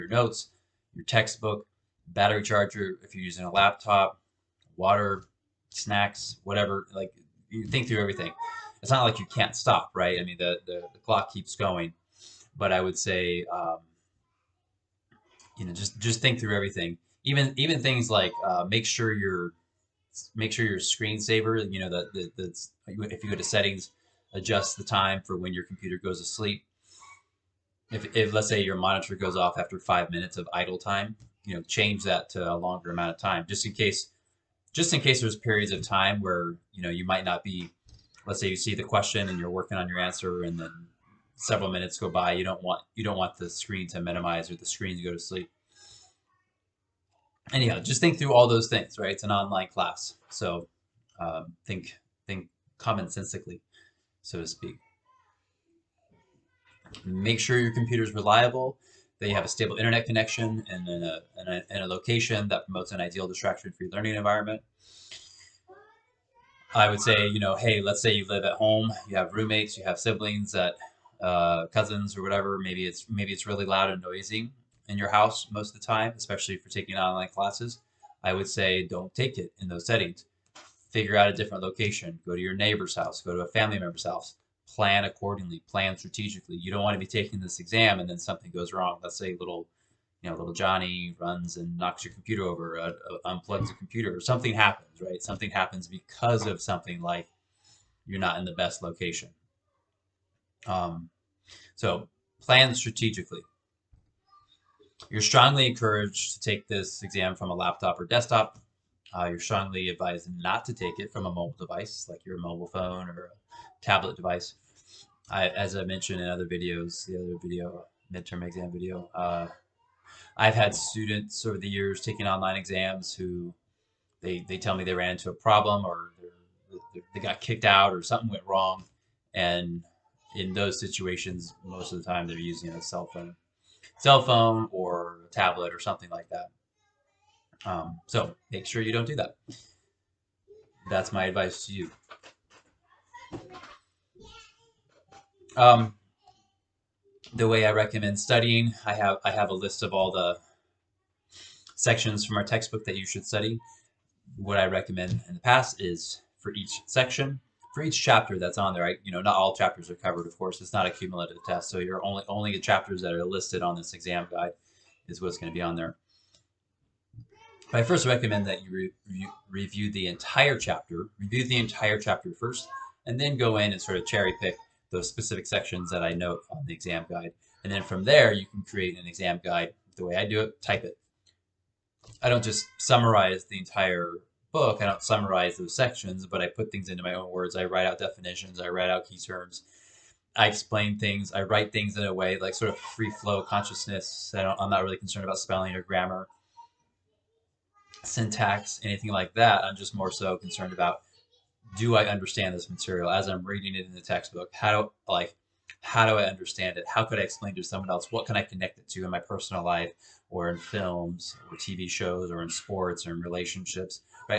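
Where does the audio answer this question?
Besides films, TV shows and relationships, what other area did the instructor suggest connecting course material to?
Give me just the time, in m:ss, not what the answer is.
3:32.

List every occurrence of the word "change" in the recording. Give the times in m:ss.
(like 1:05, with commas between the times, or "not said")
0:31.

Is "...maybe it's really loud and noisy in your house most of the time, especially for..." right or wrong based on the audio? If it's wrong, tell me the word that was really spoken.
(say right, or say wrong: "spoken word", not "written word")
right.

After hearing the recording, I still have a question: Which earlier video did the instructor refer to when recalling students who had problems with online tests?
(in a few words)
midterm exam video.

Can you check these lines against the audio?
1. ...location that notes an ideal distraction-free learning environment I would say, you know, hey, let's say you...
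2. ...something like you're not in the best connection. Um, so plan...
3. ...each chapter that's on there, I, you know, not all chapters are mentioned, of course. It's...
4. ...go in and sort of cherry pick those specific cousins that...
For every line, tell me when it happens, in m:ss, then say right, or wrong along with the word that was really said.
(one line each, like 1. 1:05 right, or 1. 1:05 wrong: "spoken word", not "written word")
1. 1:01 wrong: "promotes", not "notes"
2. 1:36 wrong: "location", not "connection"
3. 2:37 wrong: "covered", not "mentioned"
4. 2:53 wrong: "sections", not "cousins".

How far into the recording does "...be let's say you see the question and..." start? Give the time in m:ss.
0:37.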